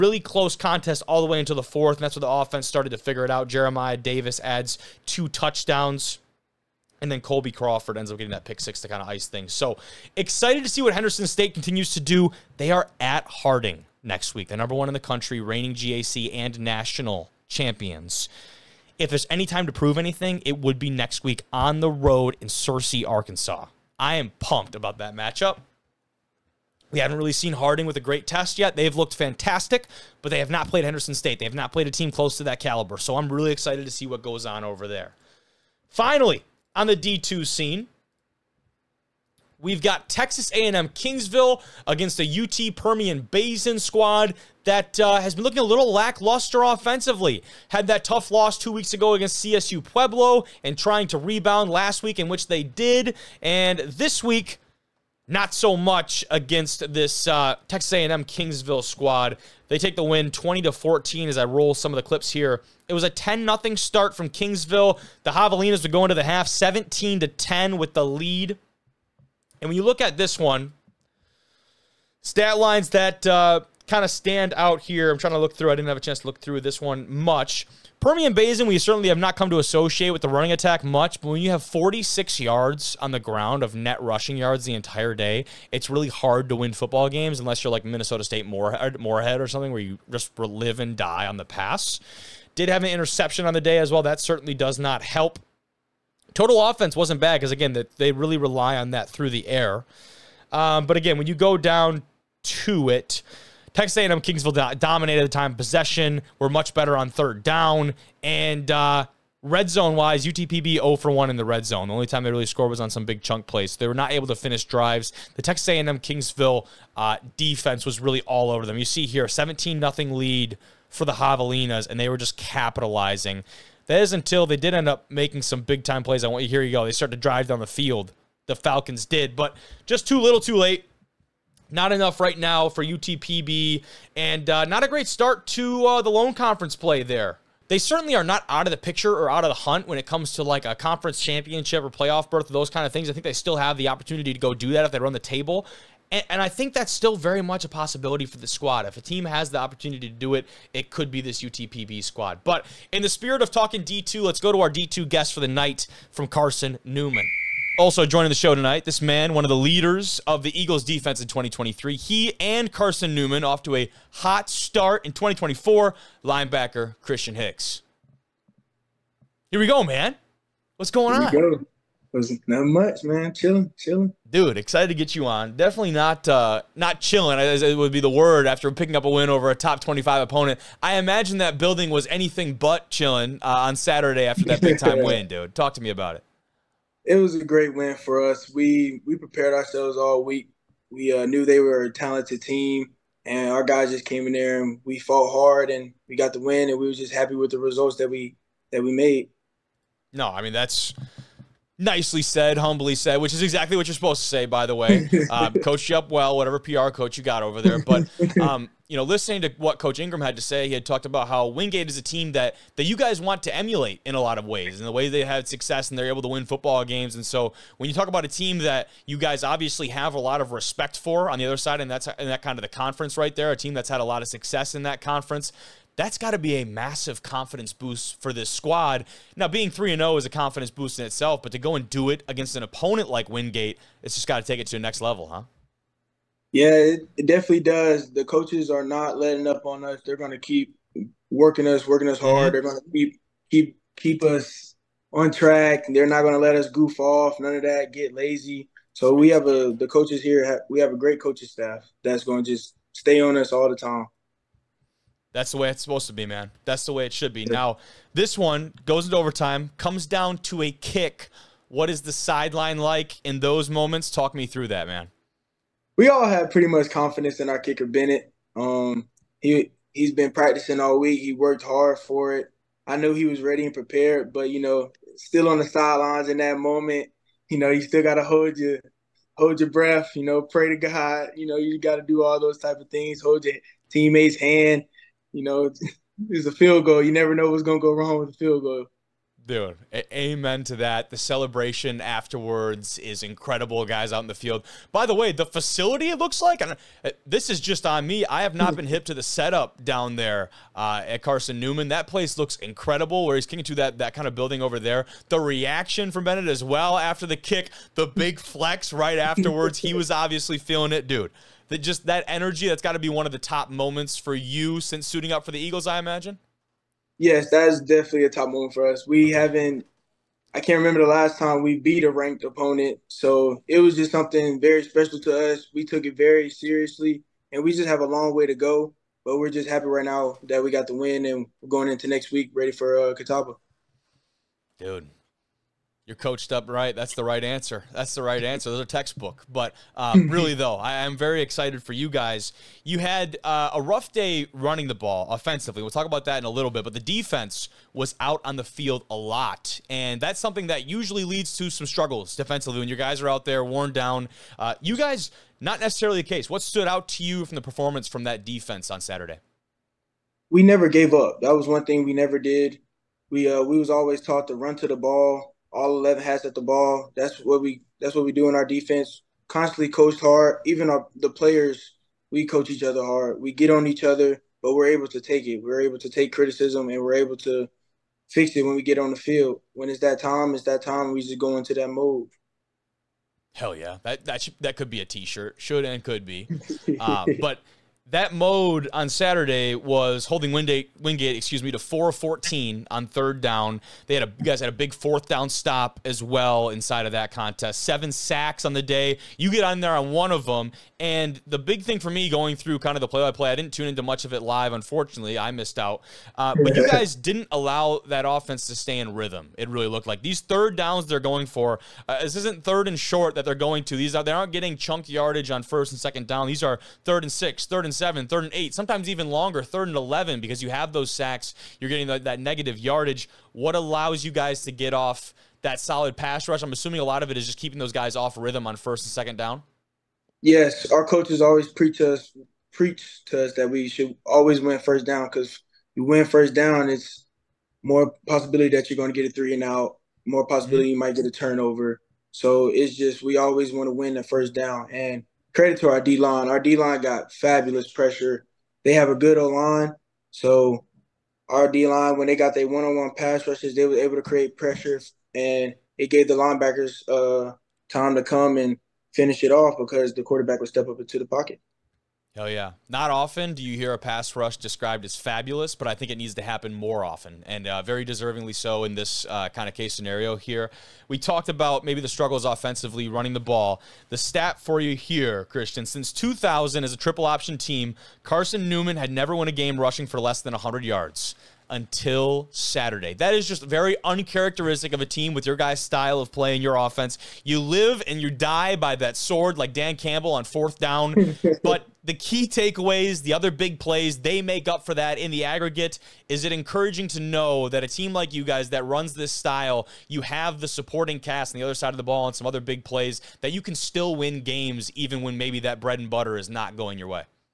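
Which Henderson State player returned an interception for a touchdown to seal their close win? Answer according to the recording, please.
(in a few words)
Colby Crawford.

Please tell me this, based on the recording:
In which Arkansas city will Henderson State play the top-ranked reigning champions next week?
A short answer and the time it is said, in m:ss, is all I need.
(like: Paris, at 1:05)
Searcy, at 0:22.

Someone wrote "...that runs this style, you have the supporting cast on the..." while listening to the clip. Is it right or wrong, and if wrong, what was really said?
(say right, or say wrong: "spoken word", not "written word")
right.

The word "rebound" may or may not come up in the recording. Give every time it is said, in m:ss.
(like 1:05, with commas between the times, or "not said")
0:51.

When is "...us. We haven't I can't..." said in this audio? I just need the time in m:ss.
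5:18.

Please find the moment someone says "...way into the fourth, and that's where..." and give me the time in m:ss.
0:01.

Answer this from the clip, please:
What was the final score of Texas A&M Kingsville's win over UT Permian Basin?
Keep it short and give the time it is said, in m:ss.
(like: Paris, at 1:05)
20 to 14, at 1:00.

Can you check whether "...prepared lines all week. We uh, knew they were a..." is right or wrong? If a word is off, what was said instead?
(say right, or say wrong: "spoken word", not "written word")
wrong: "ourselves", not "lines".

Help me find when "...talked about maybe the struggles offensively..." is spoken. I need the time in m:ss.
7:51.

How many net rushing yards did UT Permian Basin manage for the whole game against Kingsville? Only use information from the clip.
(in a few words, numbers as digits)
46.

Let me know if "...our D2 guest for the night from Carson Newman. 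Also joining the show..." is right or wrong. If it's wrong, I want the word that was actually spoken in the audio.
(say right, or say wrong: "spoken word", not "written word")
right.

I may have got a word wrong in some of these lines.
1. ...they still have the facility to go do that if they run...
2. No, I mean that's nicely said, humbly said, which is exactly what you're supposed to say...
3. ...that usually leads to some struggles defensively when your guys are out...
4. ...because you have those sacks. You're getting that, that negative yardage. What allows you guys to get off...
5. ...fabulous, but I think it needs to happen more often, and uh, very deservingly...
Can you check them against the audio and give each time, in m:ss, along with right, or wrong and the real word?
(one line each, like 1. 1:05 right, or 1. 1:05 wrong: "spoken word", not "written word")
1. 2:23 wrong: "opportunity", not "facility"
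2. 3:20 right
3. 5:50 right
4. 7:00 right
5. 7:45 right.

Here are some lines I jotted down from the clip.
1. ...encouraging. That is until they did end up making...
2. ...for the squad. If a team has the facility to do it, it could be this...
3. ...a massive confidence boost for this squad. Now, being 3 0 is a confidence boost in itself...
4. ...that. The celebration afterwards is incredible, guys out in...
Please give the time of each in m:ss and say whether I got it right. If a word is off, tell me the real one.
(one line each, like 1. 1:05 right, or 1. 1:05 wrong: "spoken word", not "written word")
1. 2:02 wrong: "capitalizing", not "encouraging"
2. 2:28 wrong: "opportunity", not "facility"
3. 3:46 right
4. 4:50 right.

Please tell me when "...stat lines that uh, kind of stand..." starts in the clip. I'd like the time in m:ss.
1:12.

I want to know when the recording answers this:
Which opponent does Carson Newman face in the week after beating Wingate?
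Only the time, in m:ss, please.
5:33.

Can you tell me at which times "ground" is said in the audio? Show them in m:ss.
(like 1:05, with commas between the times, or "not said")
1:23.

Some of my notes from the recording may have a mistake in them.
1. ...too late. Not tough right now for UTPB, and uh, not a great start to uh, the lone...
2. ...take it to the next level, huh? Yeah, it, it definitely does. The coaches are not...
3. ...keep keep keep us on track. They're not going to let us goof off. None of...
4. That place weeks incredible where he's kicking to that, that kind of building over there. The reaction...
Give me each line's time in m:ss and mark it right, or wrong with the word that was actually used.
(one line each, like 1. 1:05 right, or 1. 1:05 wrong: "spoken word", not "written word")
1. 2:10 wrong: "enough", not "tough"
2. 3:54 right
3. 4:02 right
4. 5:01 wrong: "looks", not "weeks".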